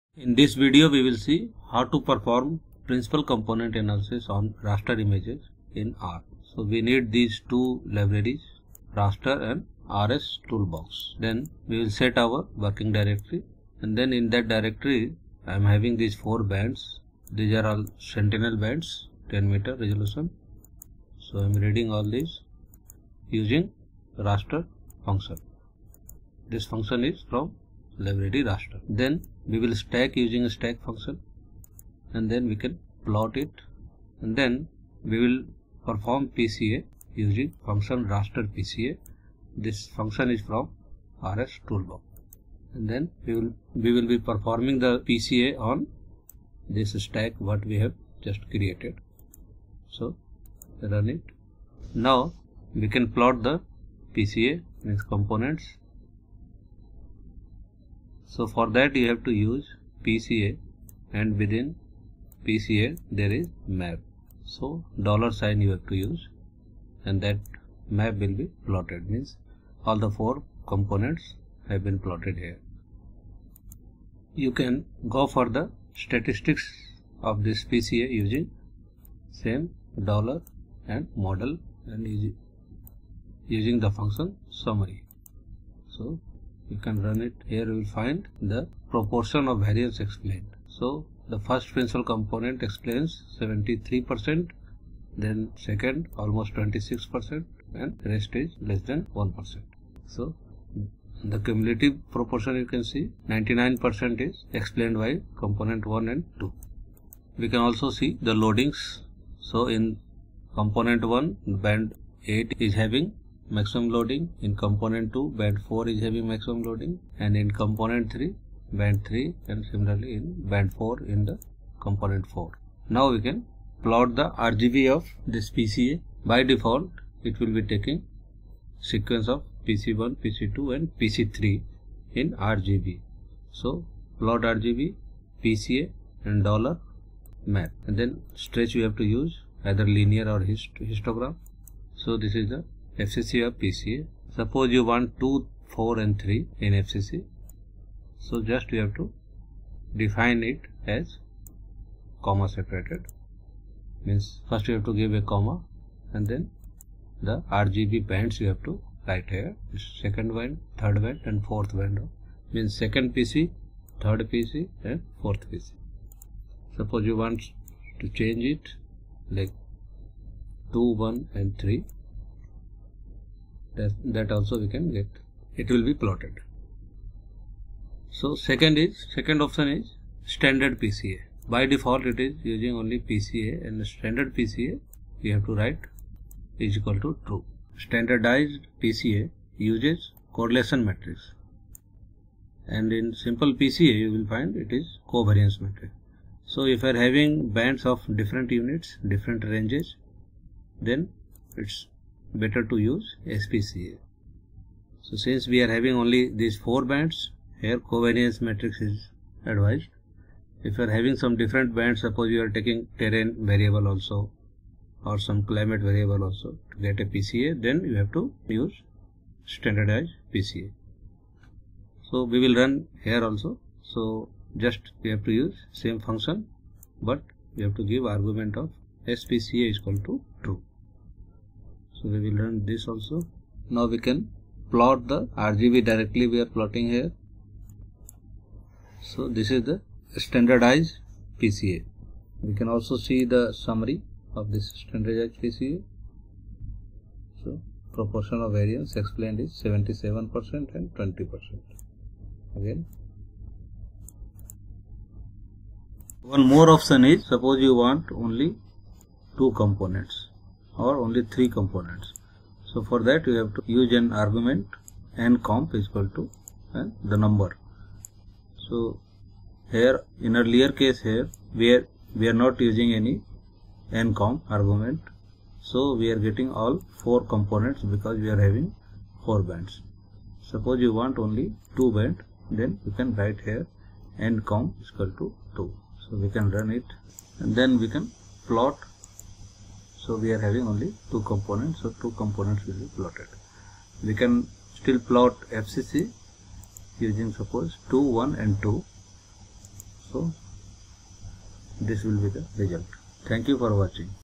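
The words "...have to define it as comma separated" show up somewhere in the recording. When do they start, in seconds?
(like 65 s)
148 s.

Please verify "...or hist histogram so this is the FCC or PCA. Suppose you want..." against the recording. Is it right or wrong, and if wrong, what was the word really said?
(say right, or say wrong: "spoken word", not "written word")
right.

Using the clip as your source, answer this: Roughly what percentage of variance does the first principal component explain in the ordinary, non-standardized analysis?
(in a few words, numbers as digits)
73 percent.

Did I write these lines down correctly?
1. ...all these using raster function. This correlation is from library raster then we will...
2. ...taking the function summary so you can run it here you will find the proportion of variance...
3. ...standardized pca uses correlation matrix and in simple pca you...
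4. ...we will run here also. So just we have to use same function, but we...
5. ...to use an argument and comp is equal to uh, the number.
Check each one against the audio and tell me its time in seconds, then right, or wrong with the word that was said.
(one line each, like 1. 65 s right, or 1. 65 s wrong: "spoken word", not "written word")
1. 21 s wrong: "function", not "correlation"
2. 83 s wrong: "using", not "taking"
3. 187 s right
4. 222 s right
5. 263 s right.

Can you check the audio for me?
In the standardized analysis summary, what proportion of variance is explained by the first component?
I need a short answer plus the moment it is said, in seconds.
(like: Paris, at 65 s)
77%, at 249 s.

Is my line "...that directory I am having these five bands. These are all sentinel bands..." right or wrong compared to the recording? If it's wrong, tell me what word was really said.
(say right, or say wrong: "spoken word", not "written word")
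wrong: "four", not "five".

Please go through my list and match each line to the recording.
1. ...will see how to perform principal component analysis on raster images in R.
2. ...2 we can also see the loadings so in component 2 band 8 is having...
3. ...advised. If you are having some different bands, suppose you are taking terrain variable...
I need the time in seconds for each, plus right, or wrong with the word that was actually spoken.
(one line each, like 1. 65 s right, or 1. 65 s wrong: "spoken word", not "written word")
1. 1 s right
2. 106 s wrong: "1", not "2"
3. 209 s right.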